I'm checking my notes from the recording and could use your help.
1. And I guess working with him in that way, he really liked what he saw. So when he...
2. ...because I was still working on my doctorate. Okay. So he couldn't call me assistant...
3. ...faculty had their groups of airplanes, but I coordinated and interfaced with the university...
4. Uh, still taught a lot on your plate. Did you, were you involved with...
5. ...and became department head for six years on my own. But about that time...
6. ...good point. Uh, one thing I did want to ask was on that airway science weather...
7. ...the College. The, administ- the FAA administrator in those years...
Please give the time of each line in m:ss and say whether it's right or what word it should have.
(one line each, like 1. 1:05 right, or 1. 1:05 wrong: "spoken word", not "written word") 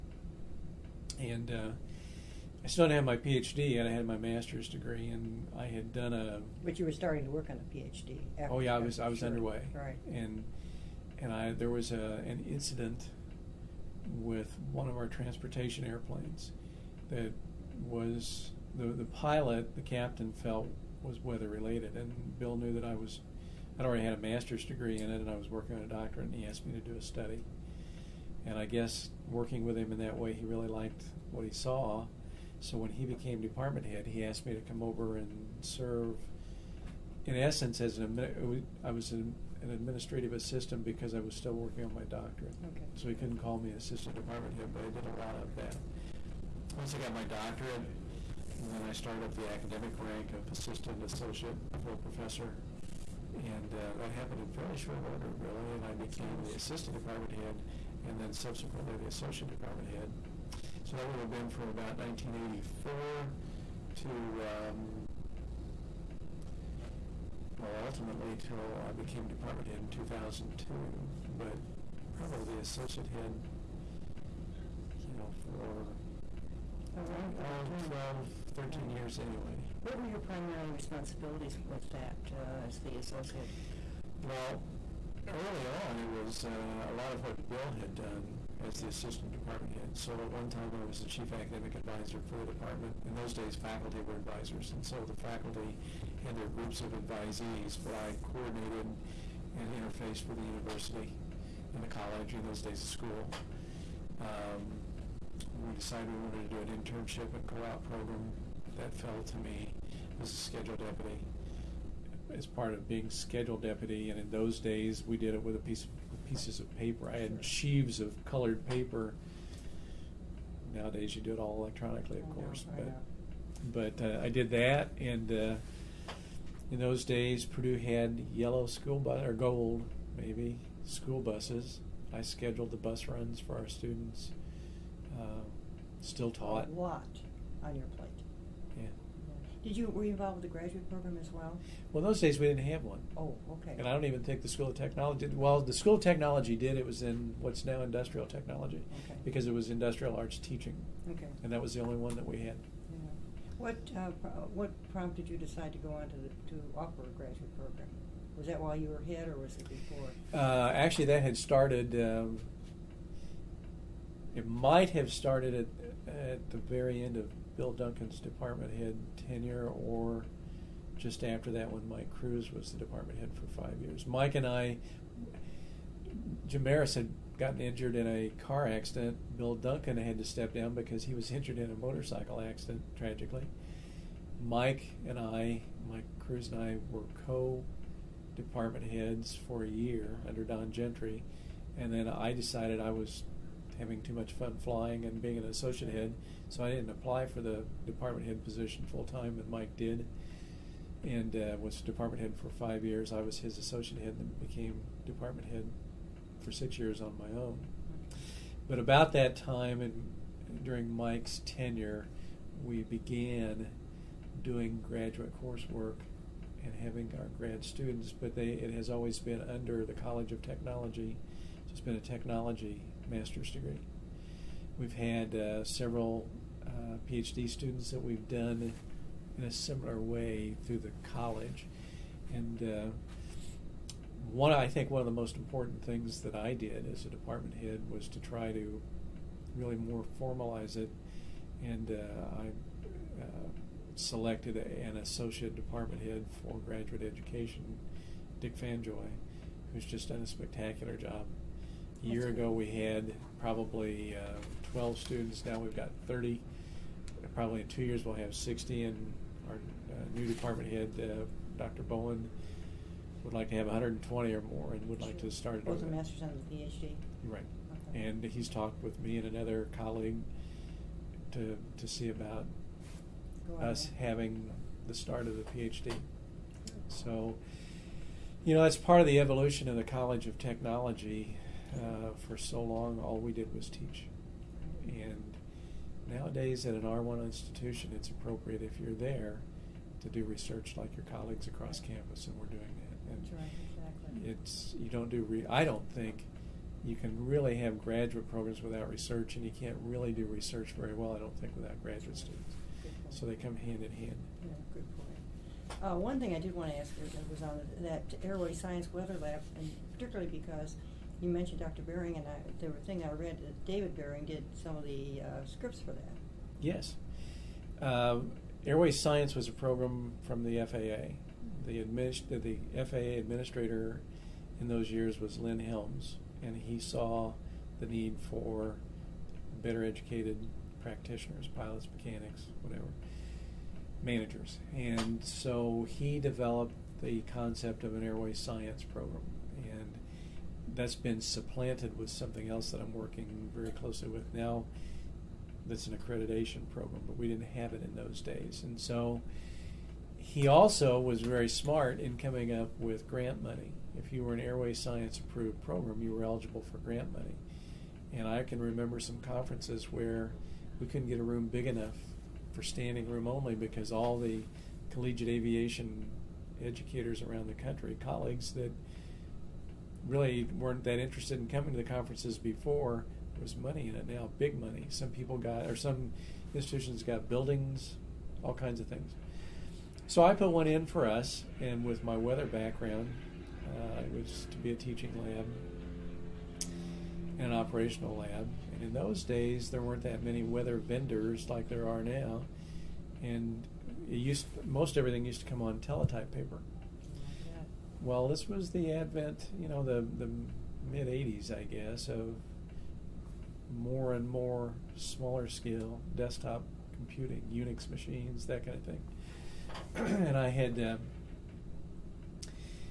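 1. 0:28 right
2. 0:40 right
3. 1:35 wrong: "advisees", not "airplanes"
4. 2:15 right
5. 3:24 right
6. 5:04 right
7. 5:20 wrong: "FAA", not "College".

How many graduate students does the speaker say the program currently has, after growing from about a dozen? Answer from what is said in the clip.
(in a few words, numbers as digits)
30.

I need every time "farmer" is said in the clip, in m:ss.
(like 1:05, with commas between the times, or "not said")
not said.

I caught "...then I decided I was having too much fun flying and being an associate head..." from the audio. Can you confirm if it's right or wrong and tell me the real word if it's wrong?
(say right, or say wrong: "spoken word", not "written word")
right.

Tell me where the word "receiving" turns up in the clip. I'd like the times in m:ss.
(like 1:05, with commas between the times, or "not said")
not said.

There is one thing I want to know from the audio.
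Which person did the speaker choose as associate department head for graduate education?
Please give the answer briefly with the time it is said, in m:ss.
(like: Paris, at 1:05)
Dick Fanjoy, at 4:08.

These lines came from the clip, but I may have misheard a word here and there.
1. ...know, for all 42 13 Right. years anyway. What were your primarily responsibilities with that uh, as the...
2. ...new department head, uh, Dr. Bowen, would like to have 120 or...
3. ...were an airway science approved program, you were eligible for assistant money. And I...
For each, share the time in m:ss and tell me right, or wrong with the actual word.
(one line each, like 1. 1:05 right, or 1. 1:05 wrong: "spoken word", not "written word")
1. 1:15 wrong: "12", not "42"
2. 4:20 right
3. 5:54 wrong: "grant", not "assistant".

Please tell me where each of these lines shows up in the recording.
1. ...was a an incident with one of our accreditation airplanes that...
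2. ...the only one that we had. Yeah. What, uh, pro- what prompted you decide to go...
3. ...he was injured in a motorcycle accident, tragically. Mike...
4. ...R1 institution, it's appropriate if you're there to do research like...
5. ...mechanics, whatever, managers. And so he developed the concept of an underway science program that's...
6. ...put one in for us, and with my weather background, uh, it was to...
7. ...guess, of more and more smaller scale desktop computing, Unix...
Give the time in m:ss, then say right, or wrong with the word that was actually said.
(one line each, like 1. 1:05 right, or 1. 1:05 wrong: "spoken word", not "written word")
1. 0:11 wrong: "transportation", not "accreditation"
2. 2:31 right
3. 3:01 right
4. 4:46 right
5. 5:31 wrong: "airway", not "underway"
6. 6:20 right
7. 6:41 right.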